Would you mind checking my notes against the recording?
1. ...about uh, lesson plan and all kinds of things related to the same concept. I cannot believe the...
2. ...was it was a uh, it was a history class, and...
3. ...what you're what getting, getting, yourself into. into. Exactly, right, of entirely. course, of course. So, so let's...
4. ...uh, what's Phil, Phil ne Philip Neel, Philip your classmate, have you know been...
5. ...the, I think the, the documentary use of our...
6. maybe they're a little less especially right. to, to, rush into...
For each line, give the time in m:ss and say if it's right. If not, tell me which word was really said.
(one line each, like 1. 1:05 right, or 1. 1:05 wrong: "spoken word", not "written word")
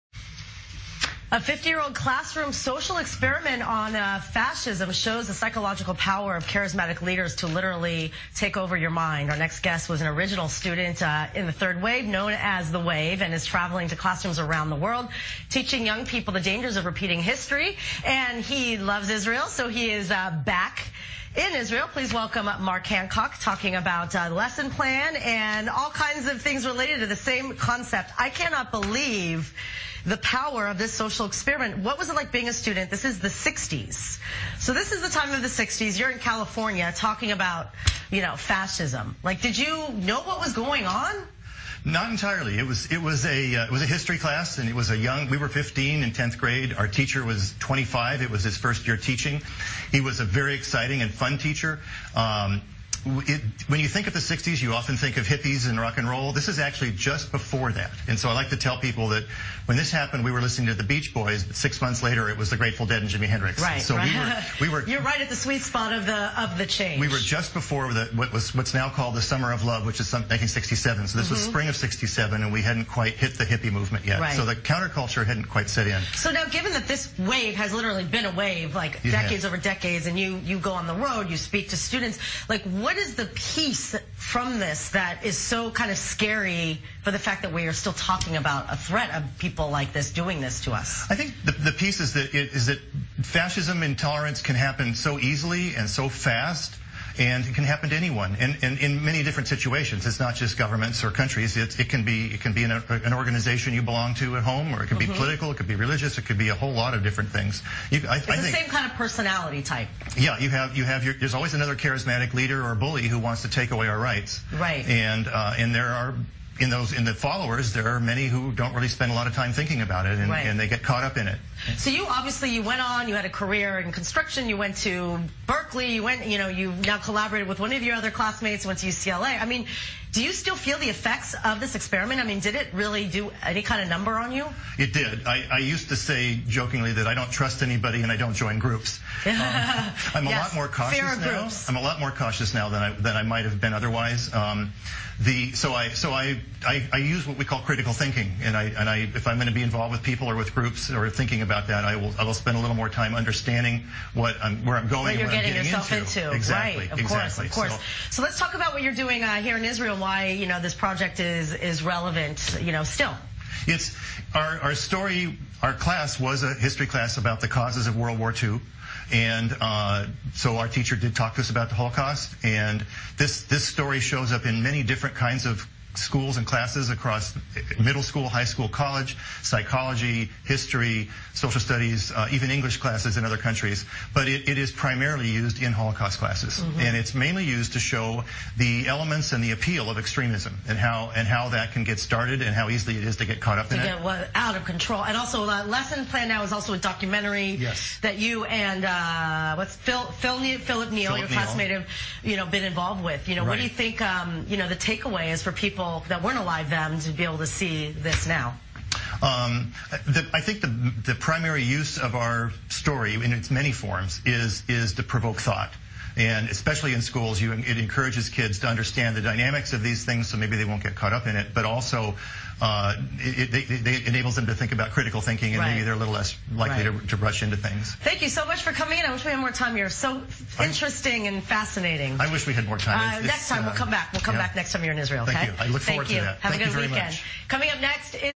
1. 0:23 right
2. 0:42 right
3. 2:35 wrong: "exactly", not "entirely"
4. 3:18 right
5. 3:30 wrong: "primary", not "documentary"
6. 3:45 wrong: "likely", not "especially".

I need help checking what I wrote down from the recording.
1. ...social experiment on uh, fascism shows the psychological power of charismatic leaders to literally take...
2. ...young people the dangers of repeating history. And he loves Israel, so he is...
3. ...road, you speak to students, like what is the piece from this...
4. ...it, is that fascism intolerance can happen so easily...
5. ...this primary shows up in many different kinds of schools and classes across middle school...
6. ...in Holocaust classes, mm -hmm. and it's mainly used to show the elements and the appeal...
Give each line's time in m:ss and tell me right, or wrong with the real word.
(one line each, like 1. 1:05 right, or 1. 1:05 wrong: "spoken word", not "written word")
1. 0:02 right
2. 0:15 right
3. 1:20 right
4. 1:32 right
5. 2:53 wrong: "story", not "primary"
6. 3:05 right.